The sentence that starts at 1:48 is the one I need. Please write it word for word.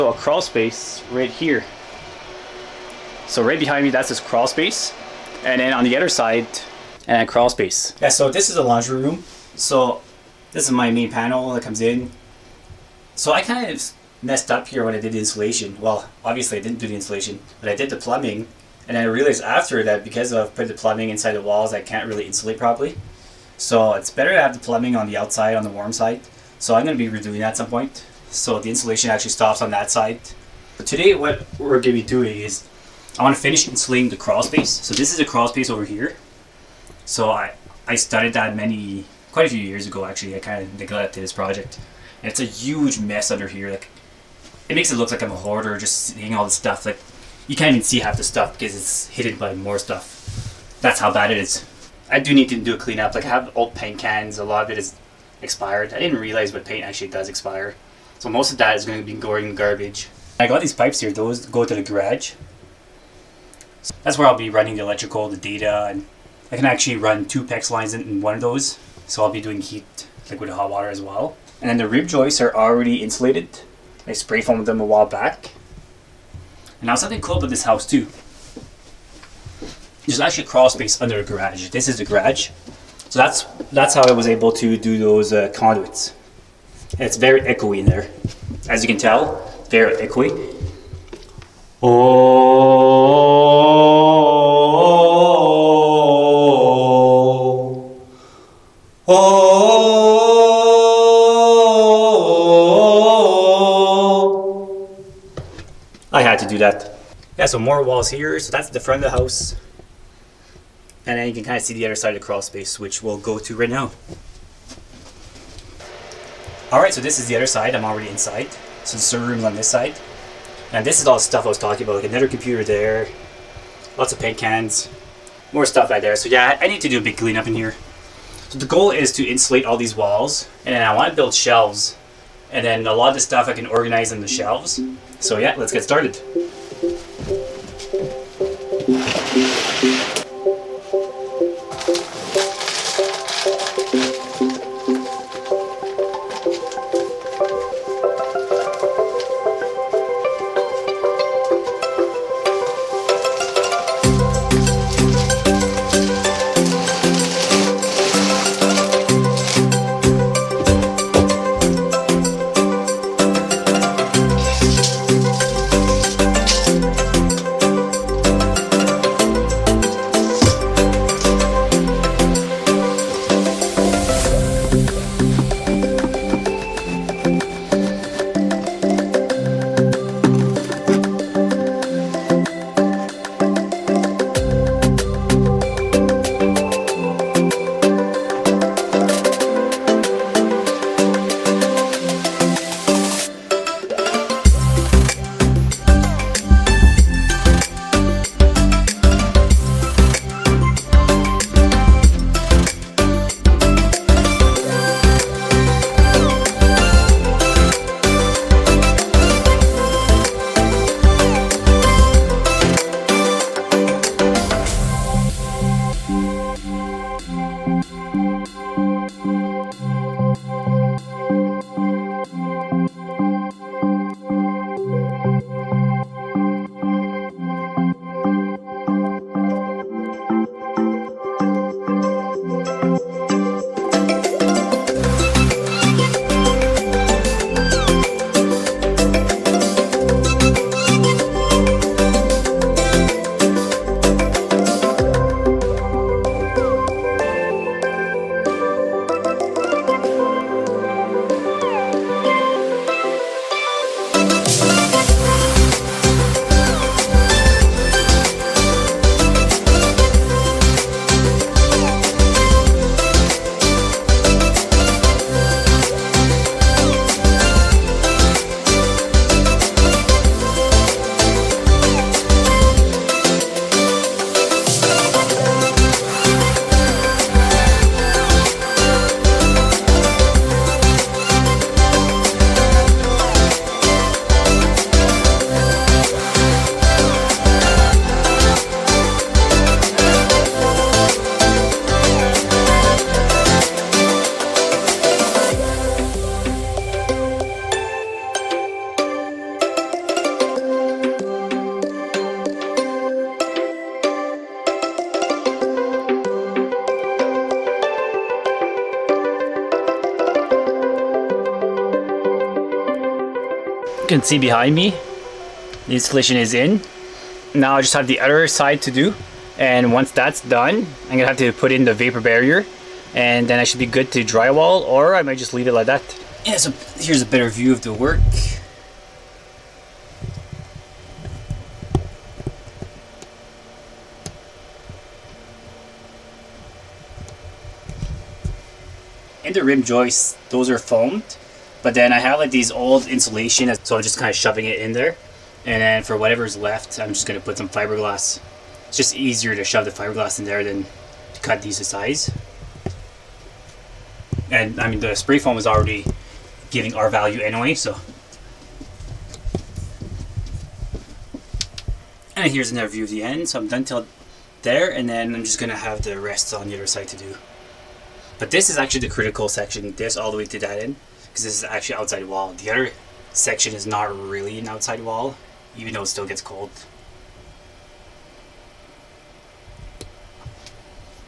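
So that's the front of the house.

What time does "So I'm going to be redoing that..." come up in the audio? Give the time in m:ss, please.
0:26.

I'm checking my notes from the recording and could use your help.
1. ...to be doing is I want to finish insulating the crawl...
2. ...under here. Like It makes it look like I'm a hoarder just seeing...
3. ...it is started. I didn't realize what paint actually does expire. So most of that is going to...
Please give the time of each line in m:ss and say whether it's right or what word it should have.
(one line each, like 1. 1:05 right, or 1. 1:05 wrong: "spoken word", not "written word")
1. 0:31 right
2. 0:43 right
3. 0:54 wrong: "expired", not "started".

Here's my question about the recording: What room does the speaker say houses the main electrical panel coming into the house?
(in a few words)
laundry room.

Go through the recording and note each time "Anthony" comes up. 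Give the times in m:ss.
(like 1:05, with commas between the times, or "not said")
not said.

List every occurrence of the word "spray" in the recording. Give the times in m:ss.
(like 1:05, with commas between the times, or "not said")
1:14, 5:55.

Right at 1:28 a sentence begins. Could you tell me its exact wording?
As you can tell, very echoey.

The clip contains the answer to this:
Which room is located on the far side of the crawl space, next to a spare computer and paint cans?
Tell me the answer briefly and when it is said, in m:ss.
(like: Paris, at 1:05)
server room, at 1:59.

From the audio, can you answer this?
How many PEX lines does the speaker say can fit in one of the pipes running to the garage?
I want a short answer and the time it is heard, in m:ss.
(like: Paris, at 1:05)
2, at 1:07.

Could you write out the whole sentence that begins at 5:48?
It's just easier to shove the fiberglass in there than to cut these to size.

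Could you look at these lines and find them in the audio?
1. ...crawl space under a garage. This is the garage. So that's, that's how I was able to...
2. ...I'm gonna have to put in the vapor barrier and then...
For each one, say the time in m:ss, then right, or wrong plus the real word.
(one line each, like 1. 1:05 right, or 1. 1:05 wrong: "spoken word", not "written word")
1. 1:20 right
2. 5:21 right.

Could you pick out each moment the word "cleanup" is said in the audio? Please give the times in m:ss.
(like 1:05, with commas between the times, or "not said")
0:52, 2:07.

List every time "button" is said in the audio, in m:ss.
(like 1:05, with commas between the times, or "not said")
not said.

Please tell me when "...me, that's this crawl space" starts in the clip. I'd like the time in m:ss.
0:03.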